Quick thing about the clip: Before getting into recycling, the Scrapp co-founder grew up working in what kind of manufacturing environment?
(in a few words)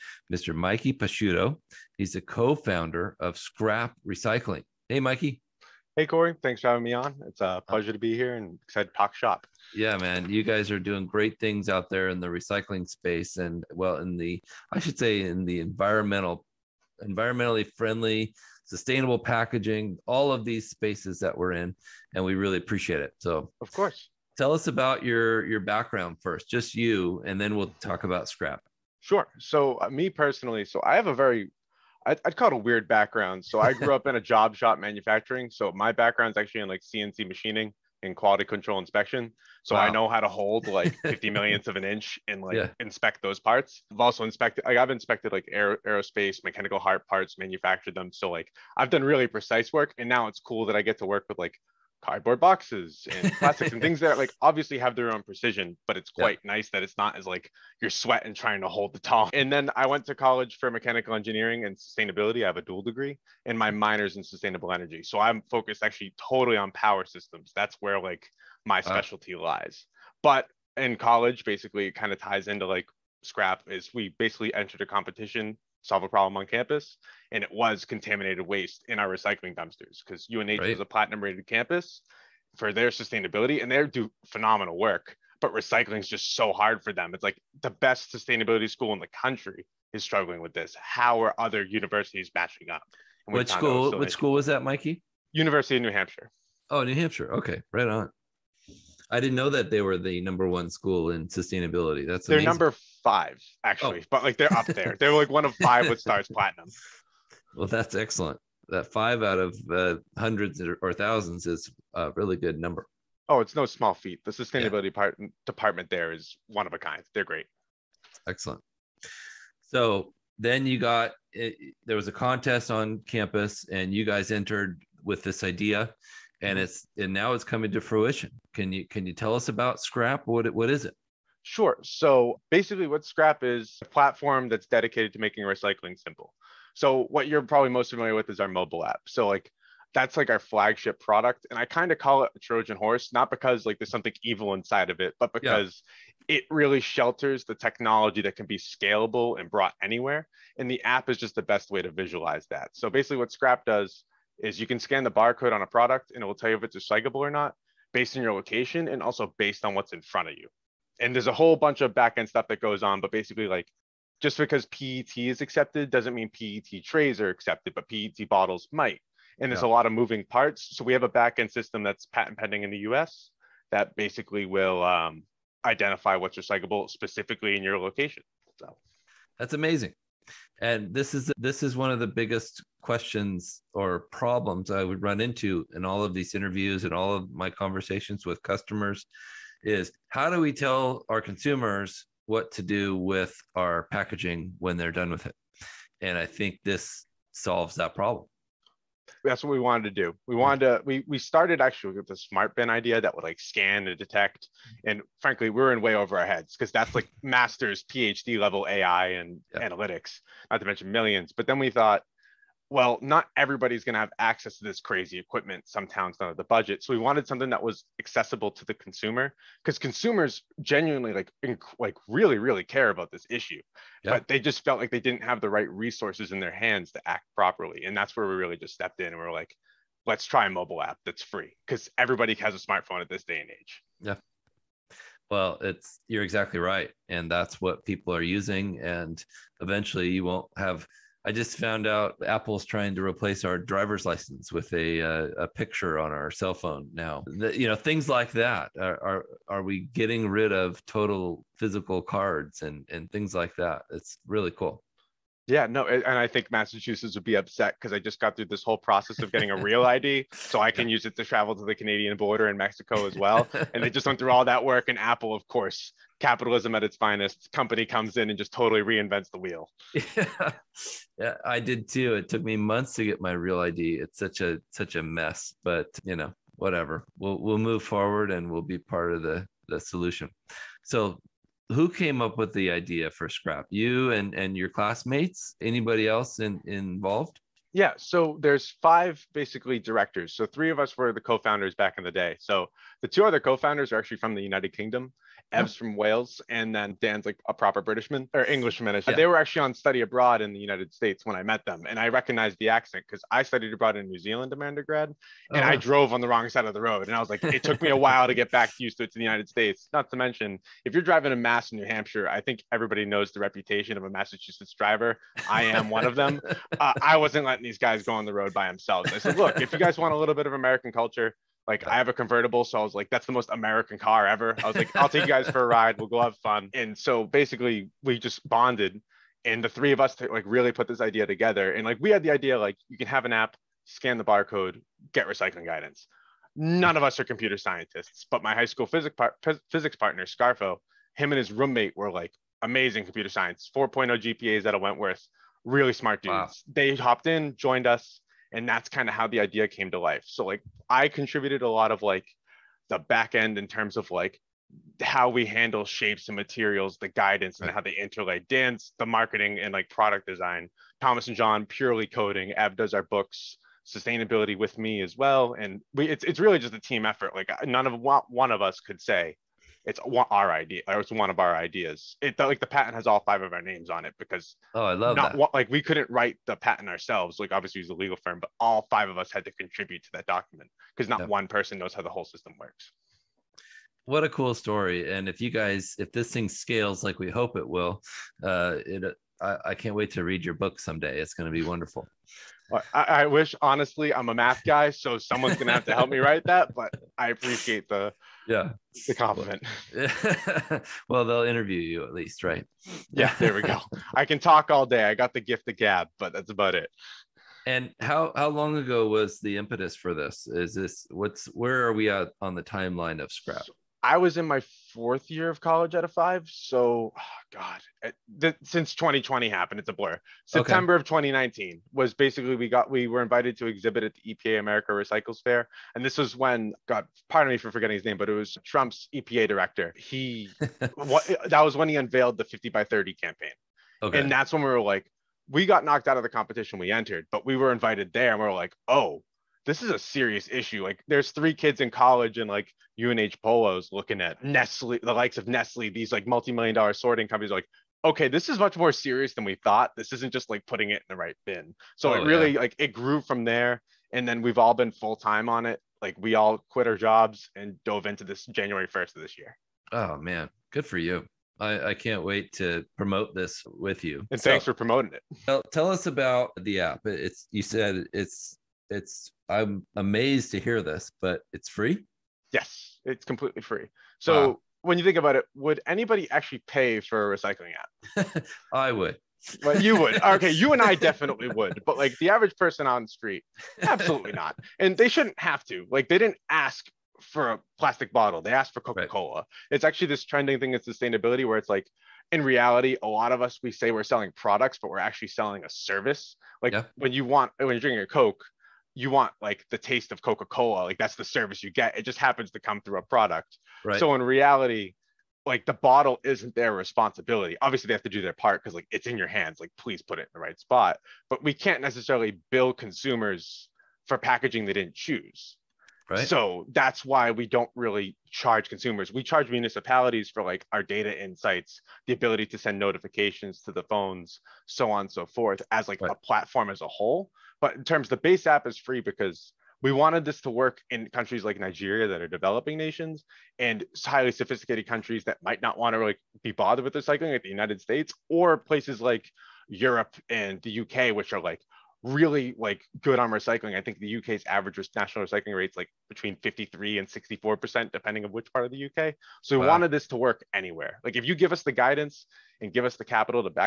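Job shop manufacturing.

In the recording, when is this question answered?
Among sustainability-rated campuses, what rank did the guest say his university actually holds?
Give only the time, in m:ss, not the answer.
1:42.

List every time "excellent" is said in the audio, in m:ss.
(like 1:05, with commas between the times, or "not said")
1:47, 1:58.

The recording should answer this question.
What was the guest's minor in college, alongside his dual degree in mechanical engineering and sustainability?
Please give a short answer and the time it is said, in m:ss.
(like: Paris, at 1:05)
Sustainable energy, at 1:04.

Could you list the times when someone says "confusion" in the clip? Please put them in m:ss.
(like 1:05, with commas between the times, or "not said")
not said.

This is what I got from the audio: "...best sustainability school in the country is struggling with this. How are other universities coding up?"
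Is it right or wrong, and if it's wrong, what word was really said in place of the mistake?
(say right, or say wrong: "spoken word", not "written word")
wrong: "matching", not "coding".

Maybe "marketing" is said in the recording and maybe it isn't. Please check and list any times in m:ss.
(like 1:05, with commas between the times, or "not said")
5:59.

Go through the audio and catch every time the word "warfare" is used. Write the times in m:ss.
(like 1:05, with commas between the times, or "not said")
not said.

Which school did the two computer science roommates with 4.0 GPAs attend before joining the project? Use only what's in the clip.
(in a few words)
Wentworth.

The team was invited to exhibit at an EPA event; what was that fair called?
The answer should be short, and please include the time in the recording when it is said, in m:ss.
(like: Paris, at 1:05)
America Recycles Fair, at 7:04.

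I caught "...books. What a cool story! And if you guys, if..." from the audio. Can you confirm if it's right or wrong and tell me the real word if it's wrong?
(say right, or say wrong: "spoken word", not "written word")
wrong: "works", not "books".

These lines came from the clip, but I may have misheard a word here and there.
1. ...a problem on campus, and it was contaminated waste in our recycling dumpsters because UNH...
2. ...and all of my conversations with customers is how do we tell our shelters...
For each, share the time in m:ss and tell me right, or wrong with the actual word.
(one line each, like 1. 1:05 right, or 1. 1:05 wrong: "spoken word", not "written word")
1. 1:16 right
2. 3:06 wrong: "consumers", not "shelters".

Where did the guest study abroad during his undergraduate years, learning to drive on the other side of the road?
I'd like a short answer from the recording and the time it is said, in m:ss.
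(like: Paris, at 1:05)
New Zealand, at 5:04.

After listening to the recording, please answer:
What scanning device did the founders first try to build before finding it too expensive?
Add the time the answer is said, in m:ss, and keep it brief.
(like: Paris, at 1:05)
Smart bin, at 3:22.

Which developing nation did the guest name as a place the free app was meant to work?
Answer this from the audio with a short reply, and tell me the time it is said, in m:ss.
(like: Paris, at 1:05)
Nigeria, at 8:51.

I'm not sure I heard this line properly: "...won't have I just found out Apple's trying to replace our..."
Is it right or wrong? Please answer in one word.
right.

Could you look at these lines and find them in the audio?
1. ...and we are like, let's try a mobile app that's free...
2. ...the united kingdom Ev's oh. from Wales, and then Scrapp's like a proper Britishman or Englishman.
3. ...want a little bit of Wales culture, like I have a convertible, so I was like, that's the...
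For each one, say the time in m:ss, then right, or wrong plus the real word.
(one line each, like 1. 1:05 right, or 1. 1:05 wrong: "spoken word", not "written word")
1. 3:49 right
2. 4:54 wrong: "Dan", not "Scrapp"
3. 5:19 wrong: "American", not "Wales".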